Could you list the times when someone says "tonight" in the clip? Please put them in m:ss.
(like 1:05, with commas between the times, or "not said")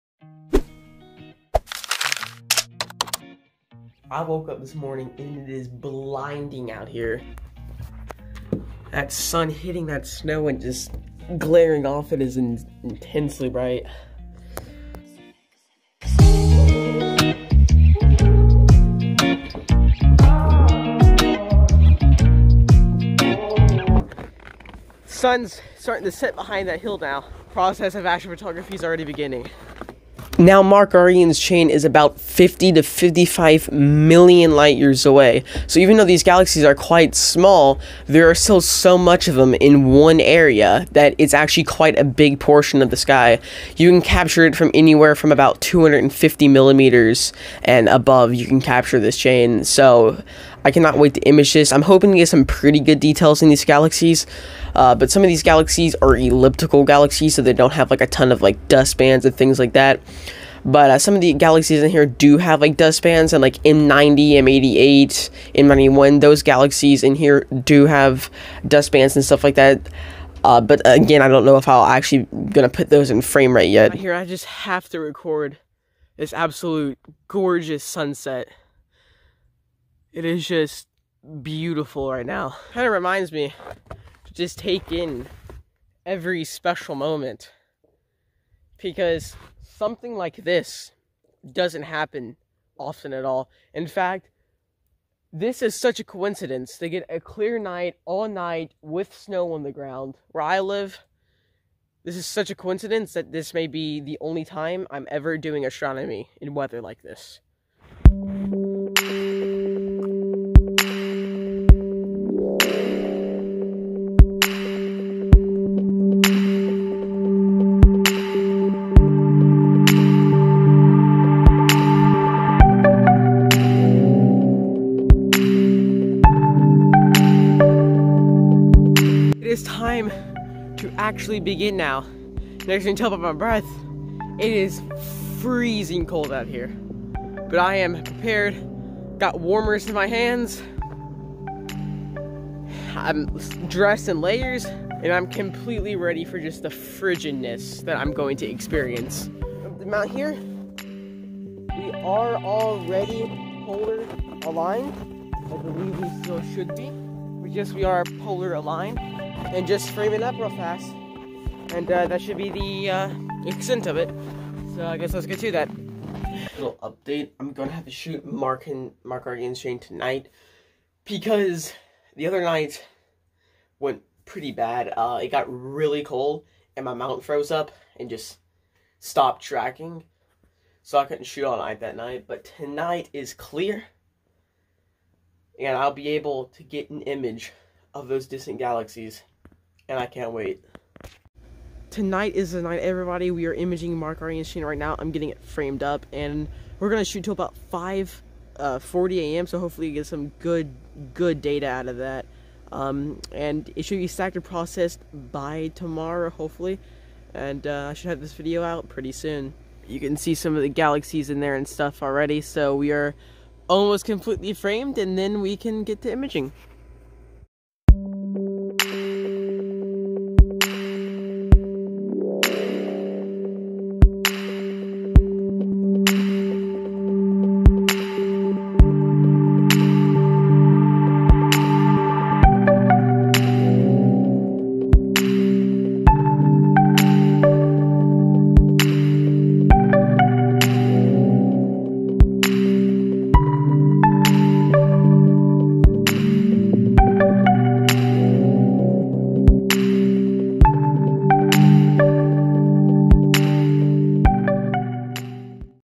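2:49, 3:02, 3:11.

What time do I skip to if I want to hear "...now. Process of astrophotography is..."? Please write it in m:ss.
0:26.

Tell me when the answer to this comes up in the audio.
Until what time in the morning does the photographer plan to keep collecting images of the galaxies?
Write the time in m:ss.
3:17.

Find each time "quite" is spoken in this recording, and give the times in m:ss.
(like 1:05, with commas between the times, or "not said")
0:36, 0:41.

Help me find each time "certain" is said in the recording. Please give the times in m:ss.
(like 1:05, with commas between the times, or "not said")
not said.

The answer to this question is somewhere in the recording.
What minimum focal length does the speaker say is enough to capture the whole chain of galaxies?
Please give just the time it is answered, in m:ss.
0:45.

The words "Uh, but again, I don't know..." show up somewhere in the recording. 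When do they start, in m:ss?
1:10.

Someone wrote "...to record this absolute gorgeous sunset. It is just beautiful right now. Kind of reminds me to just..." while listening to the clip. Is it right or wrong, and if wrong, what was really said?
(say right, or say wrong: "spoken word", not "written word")
right.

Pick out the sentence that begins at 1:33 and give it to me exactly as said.
In fact, this is such a coincidence to get a clear night all night with snow on the ground where I live.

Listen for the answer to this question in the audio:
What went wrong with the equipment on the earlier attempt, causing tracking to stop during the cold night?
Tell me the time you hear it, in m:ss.
2:56.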